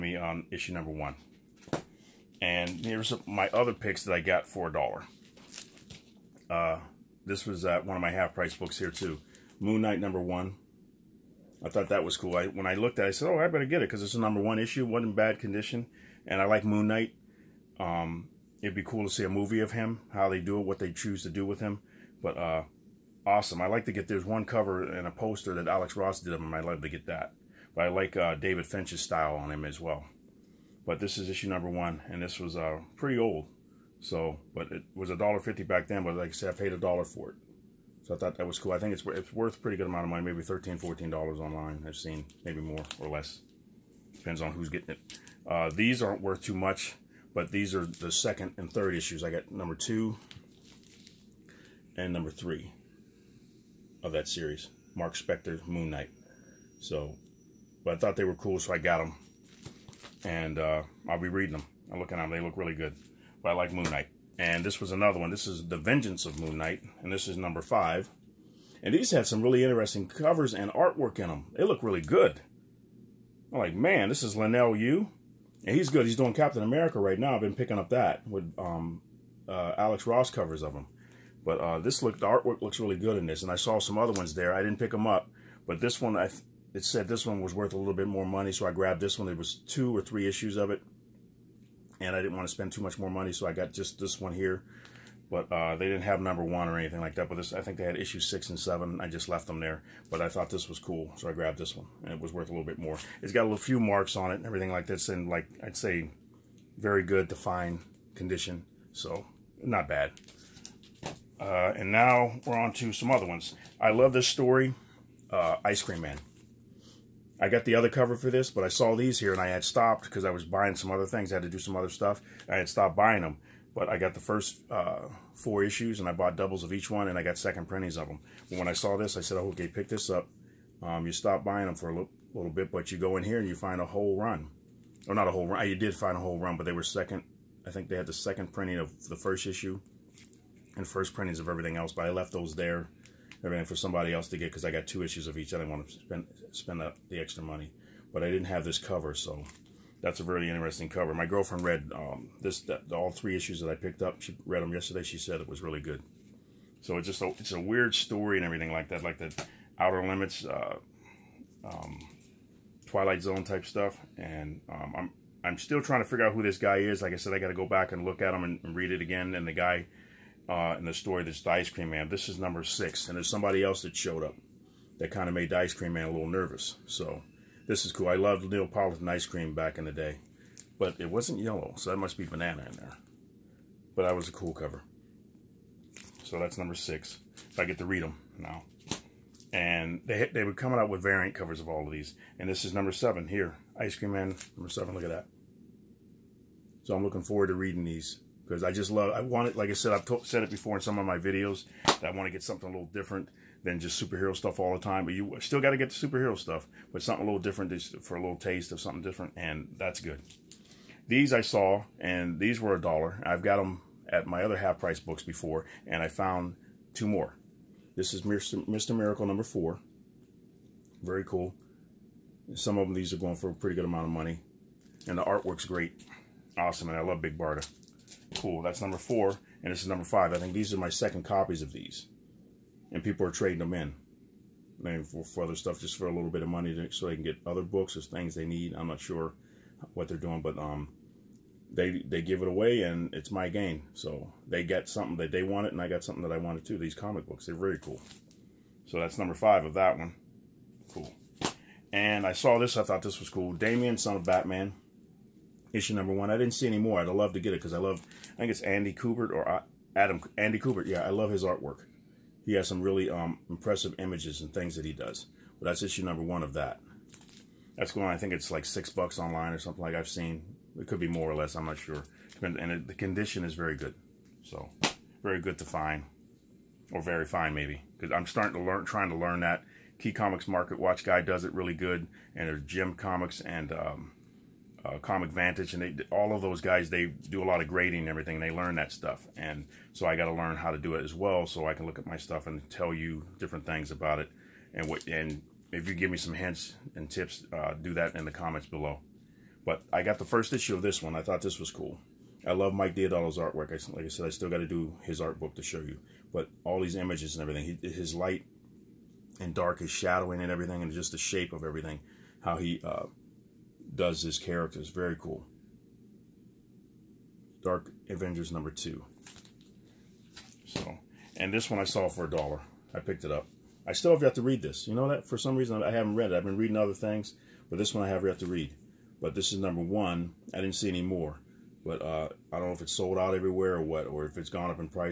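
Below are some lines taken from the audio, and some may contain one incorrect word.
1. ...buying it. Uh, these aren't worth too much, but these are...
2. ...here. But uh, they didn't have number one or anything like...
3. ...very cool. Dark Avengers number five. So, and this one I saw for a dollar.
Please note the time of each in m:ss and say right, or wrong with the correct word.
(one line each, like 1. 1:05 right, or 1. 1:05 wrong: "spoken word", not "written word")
1. 0:44 wrong: "getting", not "buying"
2. 1:34 right
3. 5:14 wrong: "two", not "five".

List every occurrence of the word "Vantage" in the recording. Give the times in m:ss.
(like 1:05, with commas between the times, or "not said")
4:45.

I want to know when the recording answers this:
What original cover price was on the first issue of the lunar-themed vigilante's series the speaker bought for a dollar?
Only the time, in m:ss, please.
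0:35.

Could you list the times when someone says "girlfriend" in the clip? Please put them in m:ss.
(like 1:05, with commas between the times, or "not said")
2:31.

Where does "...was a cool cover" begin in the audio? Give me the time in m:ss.
3:04.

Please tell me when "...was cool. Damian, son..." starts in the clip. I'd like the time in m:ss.
4:13.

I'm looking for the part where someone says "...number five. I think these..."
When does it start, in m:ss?
3:49.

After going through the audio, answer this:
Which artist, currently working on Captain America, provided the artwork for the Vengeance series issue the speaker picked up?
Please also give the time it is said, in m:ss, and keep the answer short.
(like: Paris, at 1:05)
Leinil Yu, at 1:14.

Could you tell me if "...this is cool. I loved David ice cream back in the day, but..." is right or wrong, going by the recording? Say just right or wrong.
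wrong.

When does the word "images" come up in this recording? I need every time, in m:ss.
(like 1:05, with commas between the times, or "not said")
4:23, 5:06.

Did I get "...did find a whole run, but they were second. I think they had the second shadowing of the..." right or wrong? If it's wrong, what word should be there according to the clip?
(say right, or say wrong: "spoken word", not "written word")
wrong: "printing", not "shadowing".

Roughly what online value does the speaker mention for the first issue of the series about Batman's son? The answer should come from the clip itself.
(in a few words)
$6.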